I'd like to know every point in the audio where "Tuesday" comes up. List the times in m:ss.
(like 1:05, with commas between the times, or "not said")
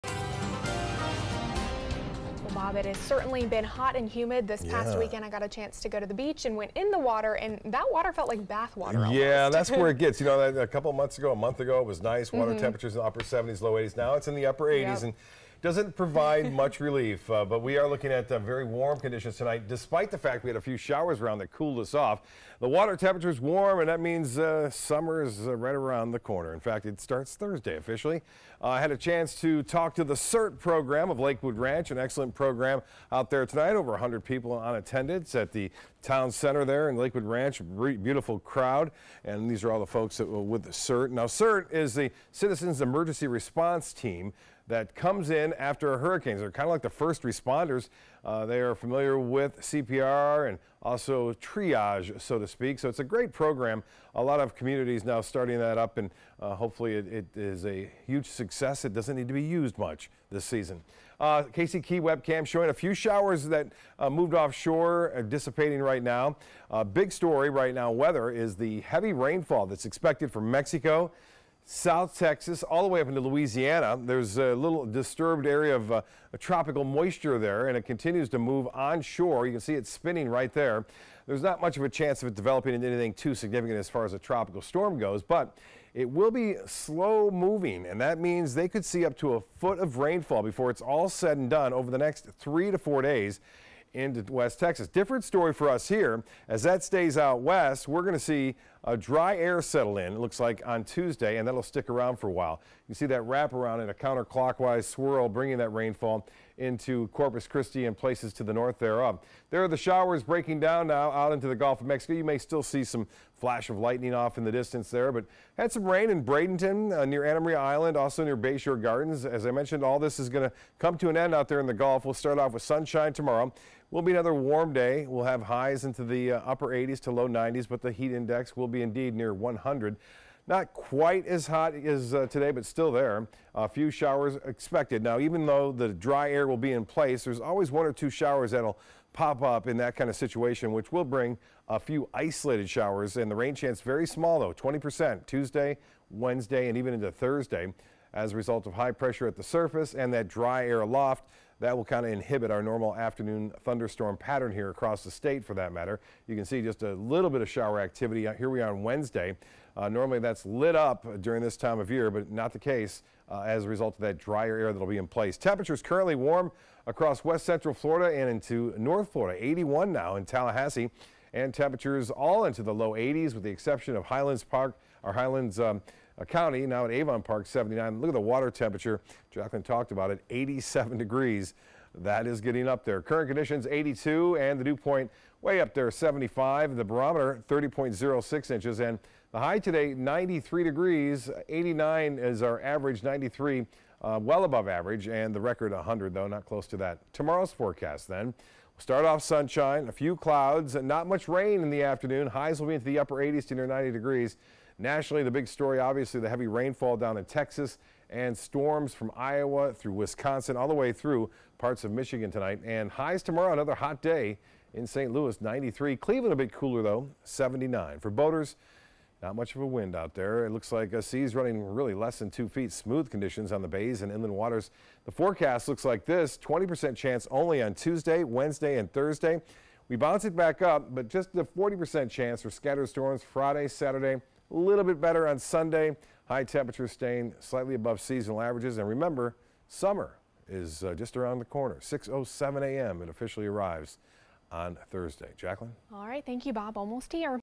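1:40, 2:25, 3:47.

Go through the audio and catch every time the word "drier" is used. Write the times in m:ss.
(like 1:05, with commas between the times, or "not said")
2:44.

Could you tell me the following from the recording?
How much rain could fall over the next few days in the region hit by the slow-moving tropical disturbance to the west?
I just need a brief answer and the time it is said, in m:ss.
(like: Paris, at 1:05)
Up to a foot, at 1:29.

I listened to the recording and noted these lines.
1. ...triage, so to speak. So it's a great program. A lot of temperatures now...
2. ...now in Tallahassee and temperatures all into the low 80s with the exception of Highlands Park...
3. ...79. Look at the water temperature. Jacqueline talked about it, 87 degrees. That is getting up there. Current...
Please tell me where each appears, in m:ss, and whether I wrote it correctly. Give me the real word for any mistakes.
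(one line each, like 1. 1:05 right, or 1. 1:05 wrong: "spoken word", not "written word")
1. 0:51 wrong: "communities", not "temperatures"
2. 2:49 right
3. 2:57 right.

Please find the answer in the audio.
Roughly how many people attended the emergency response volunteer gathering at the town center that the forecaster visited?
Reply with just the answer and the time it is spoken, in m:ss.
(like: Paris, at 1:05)
Over 100, at 0:33.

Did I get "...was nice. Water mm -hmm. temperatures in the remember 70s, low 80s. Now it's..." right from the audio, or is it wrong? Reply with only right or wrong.
wrong.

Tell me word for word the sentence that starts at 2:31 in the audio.
That will kind of inhibit our normal afternoon thunderstorm pattern here across the state for that matter.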